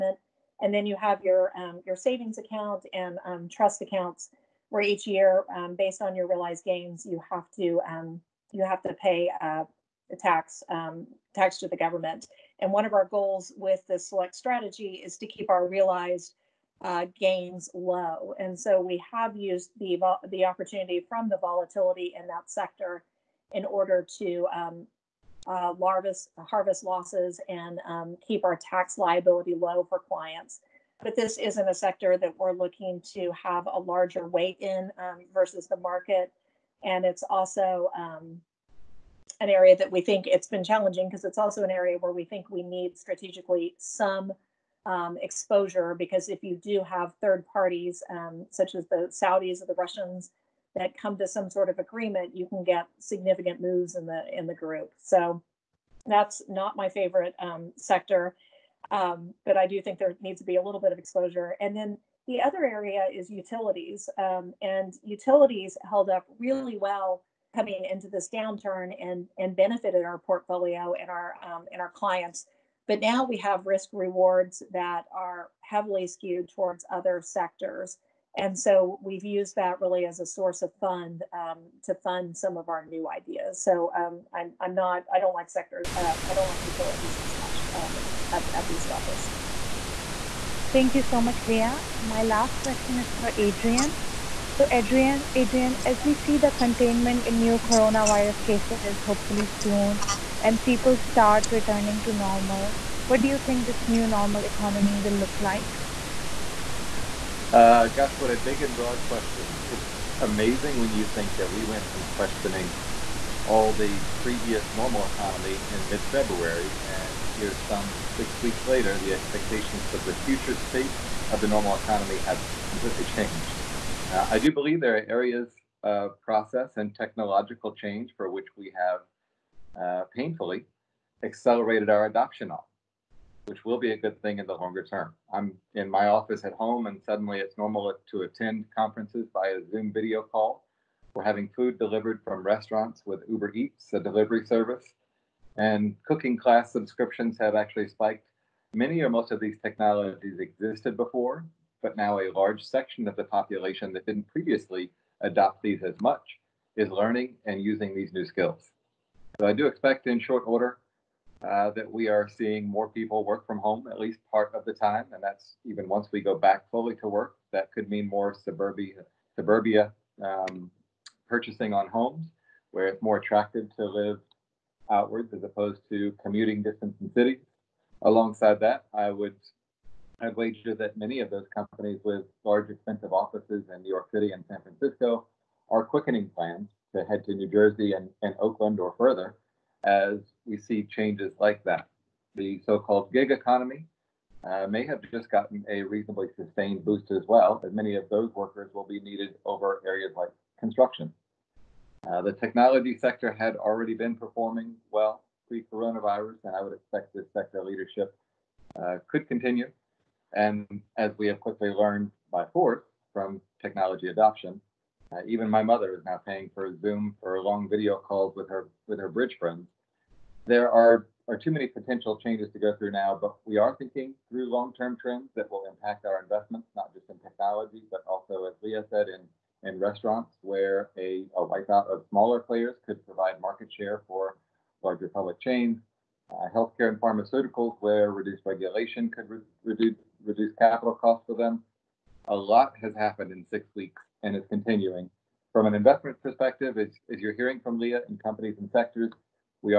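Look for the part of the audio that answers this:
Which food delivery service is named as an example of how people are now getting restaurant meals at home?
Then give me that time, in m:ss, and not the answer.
2:23.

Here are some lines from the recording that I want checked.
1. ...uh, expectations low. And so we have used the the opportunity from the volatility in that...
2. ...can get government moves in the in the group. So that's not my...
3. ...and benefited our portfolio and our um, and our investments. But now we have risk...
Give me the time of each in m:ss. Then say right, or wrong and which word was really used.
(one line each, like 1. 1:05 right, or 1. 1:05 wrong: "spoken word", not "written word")
1. 0:16 wrong: "gains", not "expectations"
2. 0:52 wrong: "significant", not "government"
3. 1:09 wrong: "clients", not "investments".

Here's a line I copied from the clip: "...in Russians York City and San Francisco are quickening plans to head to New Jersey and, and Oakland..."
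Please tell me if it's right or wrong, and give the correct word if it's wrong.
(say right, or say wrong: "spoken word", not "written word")
wrong: "New", not "Russians".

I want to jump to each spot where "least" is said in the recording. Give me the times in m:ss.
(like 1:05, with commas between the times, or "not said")
2:43.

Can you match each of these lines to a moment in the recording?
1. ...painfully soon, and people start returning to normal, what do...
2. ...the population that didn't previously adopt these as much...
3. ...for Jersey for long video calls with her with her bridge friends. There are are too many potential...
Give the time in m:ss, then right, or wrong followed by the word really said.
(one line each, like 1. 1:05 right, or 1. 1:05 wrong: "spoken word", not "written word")
1. 1:39 wrong: "hopefully", not "painfully"
2. 2:33 right
3. 3:36 wrong: "Zoom", not "Jersey".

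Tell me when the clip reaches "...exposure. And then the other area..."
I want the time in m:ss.
1:00.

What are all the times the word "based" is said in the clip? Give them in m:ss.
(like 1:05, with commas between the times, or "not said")
0:05.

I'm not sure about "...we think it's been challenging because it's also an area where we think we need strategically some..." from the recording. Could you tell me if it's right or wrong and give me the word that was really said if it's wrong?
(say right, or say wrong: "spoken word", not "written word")
right.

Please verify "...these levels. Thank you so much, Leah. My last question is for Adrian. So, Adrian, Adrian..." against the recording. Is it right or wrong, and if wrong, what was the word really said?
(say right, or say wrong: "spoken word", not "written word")
right.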